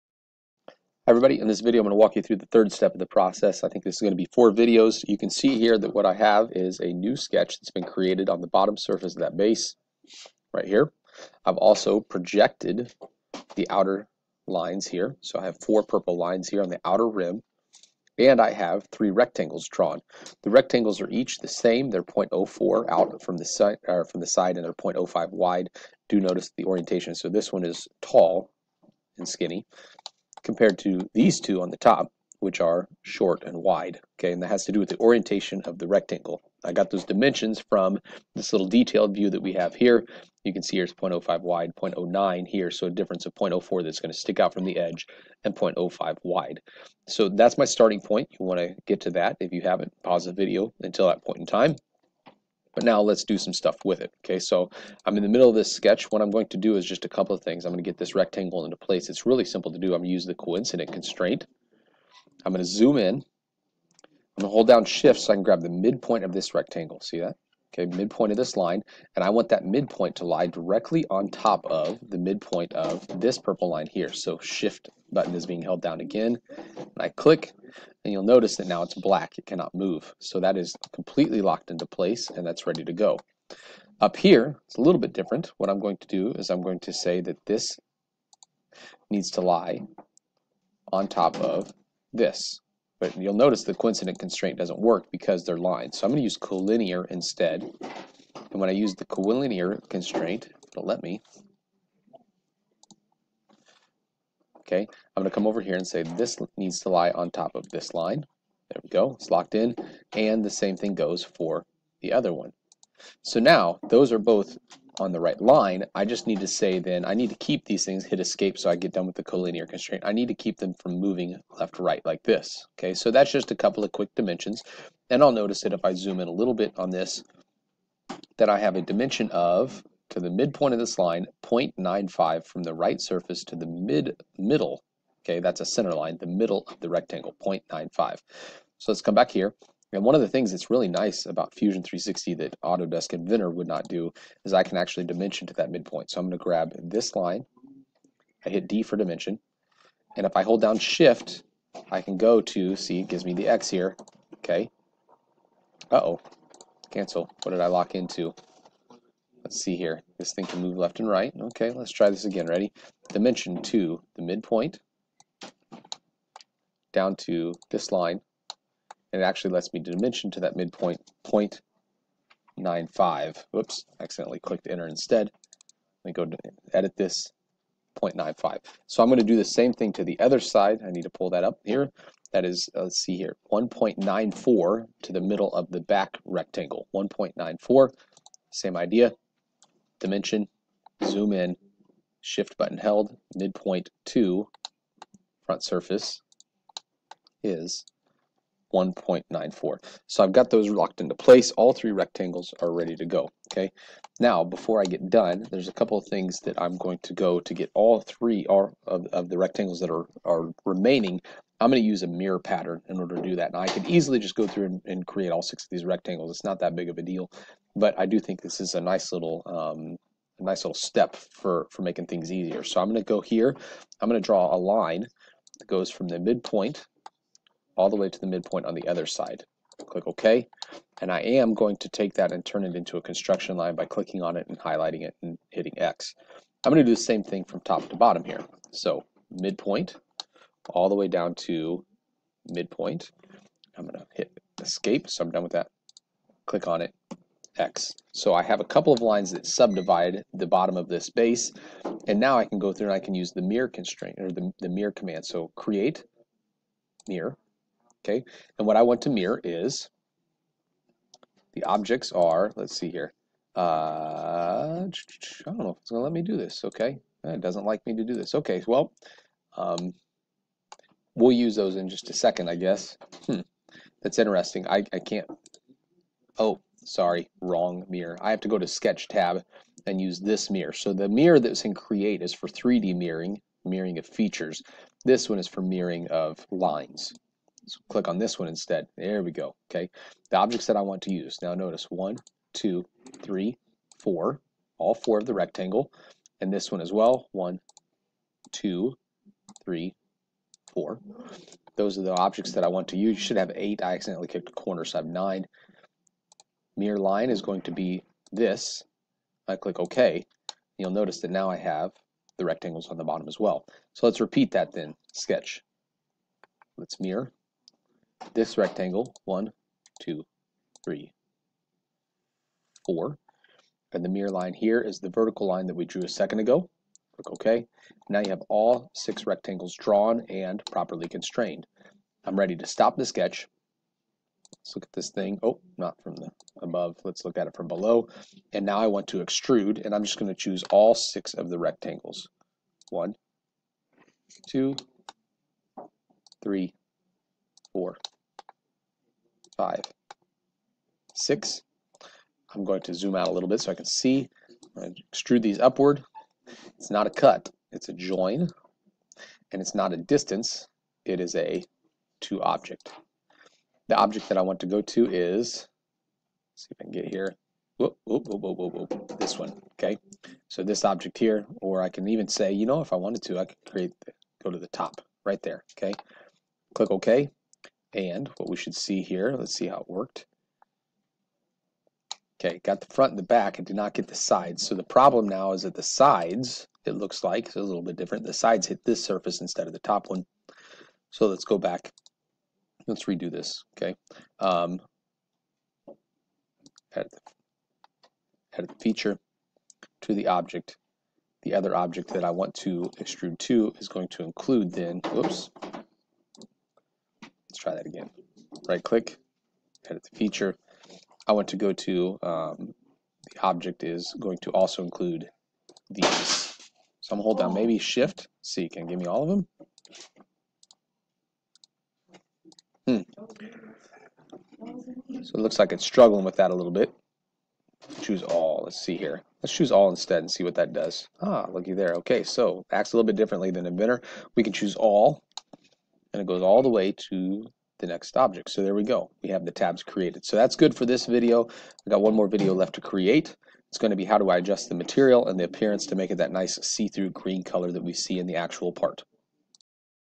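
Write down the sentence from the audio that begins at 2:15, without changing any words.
Okay, that's a center line, the middle of the rectangle, 0.95.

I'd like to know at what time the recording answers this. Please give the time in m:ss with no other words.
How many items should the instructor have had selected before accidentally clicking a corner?
5:03.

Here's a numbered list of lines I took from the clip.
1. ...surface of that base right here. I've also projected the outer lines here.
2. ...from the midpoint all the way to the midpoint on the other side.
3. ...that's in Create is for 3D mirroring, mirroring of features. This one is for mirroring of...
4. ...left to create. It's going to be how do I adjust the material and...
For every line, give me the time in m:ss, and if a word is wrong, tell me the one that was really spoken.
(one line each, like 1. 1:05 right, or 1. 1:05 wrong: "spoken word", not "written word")
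1. 0:08 right
2. 3:45 right
3. 4:41 right
4. 7:22 right.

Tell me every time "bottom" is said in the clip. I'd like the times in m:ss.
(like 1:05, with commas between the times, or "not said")
0:08, 3:57, 4:10, 5:13.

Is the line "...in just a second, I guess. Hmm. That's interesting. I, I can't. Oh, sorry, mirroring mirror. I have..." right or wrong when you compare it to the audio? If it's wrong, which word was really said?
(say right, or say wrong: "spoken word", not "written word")
wrong: "wrong", not "mirroring".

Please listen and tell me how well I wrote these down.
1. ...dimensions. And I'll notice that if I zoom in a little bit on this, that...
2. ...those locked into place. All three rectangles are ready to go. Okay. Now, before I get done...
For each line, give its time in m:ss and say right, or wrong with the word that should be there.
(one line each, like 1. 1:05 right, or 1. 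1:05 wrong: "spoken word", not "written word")
1. 2:04 right
2. 3:20 right.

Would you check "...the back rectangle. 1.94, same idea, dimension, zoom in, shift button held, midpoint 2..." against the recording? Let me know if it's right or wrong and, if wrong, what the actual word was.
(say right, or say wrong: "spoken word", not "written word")
right.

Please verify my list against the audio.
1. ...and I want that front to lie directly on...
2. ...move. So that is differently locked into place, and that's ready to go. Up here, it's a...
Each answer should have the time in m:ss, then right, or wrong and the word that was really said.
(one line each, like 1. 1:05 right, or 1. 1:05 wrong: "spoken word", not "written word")
1. 1:09 wrong: "midpoint", not "front"
2. 1:19 wrong: "completely", not "differently".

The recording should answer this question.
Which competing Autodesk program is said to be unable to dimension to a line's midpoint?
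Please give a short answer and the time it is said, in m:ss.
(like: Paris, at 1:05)
Autodesk Inventor, at 2:22.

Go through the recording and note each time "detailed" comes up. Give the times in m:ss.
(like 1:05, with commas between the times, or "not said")
0:38.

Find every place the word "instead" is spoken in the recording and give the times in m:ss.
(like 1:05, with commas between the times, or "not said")
1:37, 2:54, 4:48, 6:29, 7:09.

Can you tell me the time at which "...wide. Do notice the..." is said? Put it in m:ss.
0:25.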